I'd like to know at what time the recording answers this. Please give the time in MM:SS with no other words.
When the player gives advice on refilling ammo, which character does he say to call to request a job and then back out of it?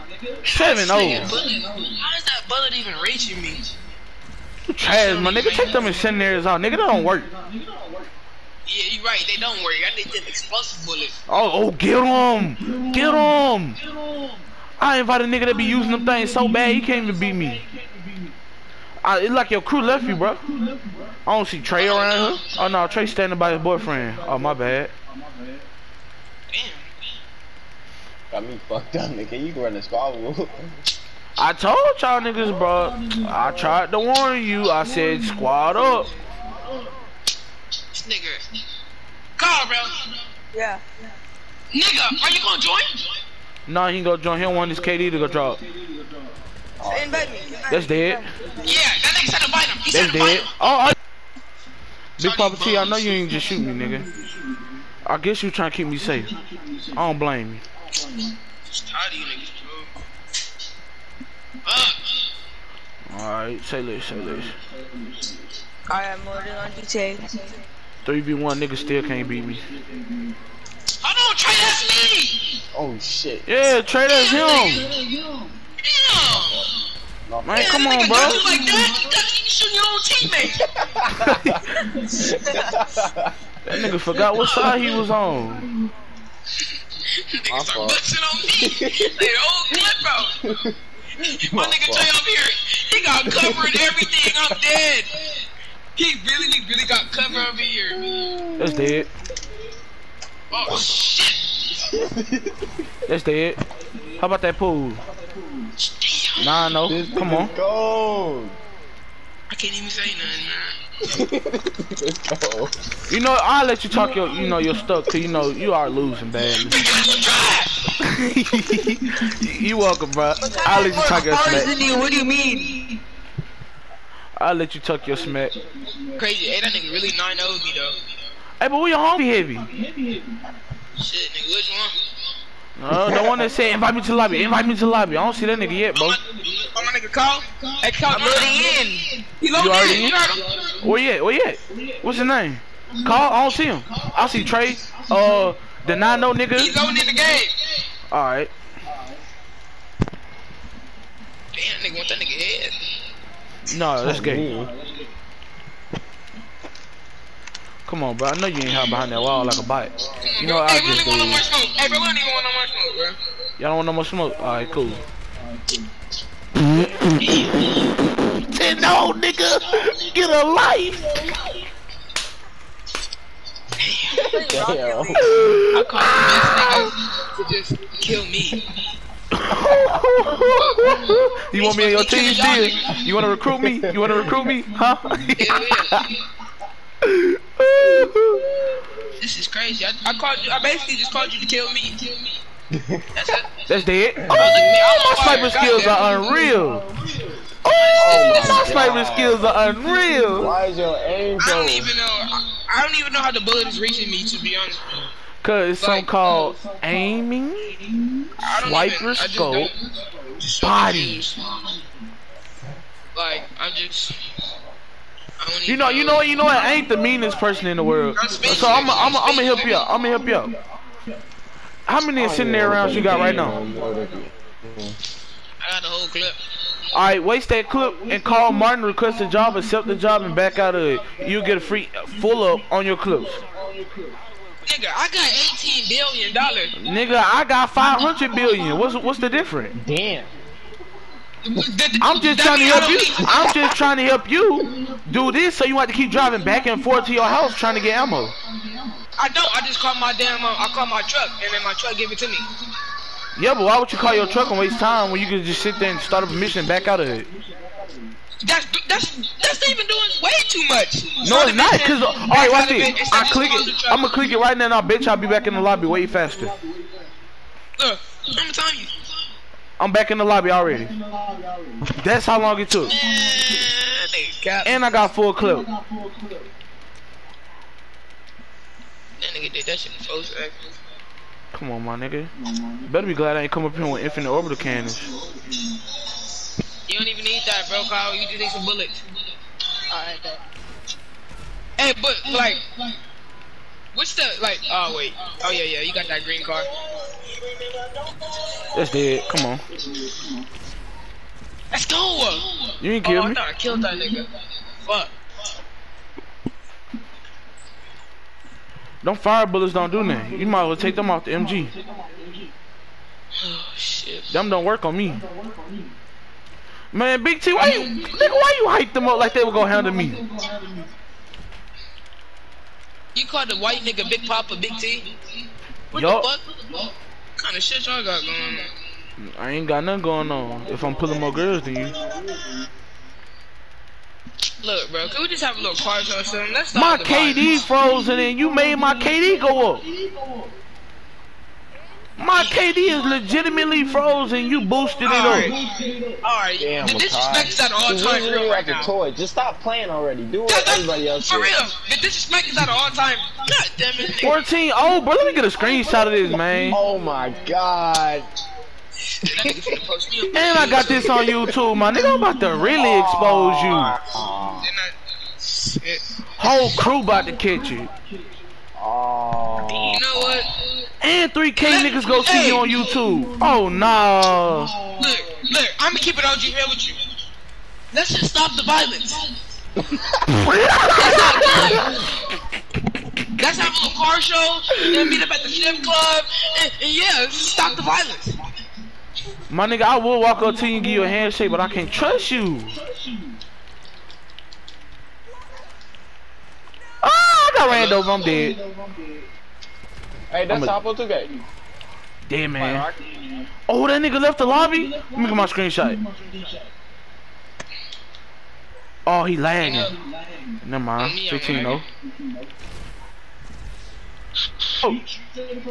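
03:48.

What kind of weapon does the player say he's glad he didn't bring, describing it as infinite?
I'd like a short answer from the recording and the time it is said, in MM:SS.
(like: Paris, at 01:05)
Orbital cannons, at 04:44.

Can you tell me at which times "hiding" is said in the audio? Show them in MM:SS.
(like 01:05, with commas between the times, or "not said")
02:38.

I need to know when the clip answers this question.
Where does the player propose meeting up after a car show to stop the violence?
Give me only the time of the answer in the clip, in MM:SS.
06:25.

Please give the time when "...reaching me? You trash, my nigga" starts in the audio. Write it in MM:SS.
00:03.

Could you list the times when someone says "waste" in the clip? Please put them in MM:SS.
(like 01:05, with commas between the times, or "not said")
03:47, 04:14.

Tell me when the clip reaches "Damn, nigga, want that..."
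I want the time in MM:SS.
02:30.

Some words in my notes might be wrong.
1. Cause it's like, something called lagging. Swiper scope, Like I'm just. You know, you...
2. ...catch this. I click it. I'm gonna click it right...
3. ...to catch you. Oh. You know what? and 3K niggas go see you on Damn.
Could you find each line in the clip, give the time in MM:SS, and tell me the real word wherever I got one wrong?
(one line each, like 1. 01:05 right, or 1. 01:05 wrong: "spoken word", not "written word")
1. 03:25 wrong: "aiming", not "lagging"
2. 04:22 wrong: "watch", not "catch"
3. 06:07 wrong: "YouTube", not "Damn".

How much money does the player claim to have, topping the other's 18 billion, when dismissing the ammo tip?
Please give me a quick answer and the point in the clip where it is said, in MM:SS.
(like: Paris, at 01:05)
500 billion, at 03:57.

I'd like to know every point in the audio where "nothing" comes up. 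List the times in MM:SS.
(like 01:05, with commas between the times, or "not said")
01:50, 05:10, 05:29.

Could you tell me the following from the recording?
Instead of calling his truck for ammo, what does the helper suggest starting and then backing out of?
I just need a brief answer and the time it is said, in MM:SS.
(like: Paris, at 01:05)
A mission, at 04:16.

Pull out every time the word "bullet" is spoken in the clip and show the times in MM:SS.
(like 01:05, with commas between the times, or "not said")
00:02, 03:23, 04:48, 05:09.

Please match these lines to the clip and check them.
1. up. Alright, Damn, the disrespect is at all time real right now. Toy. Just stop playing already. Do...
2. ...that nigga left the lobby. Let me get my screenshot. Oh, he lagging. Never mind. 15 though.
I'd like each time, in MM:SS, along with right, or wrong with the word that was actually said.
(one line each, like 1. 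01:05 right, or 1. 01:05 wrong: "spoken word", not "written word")
1. 05:45 right
2. 06:43 right.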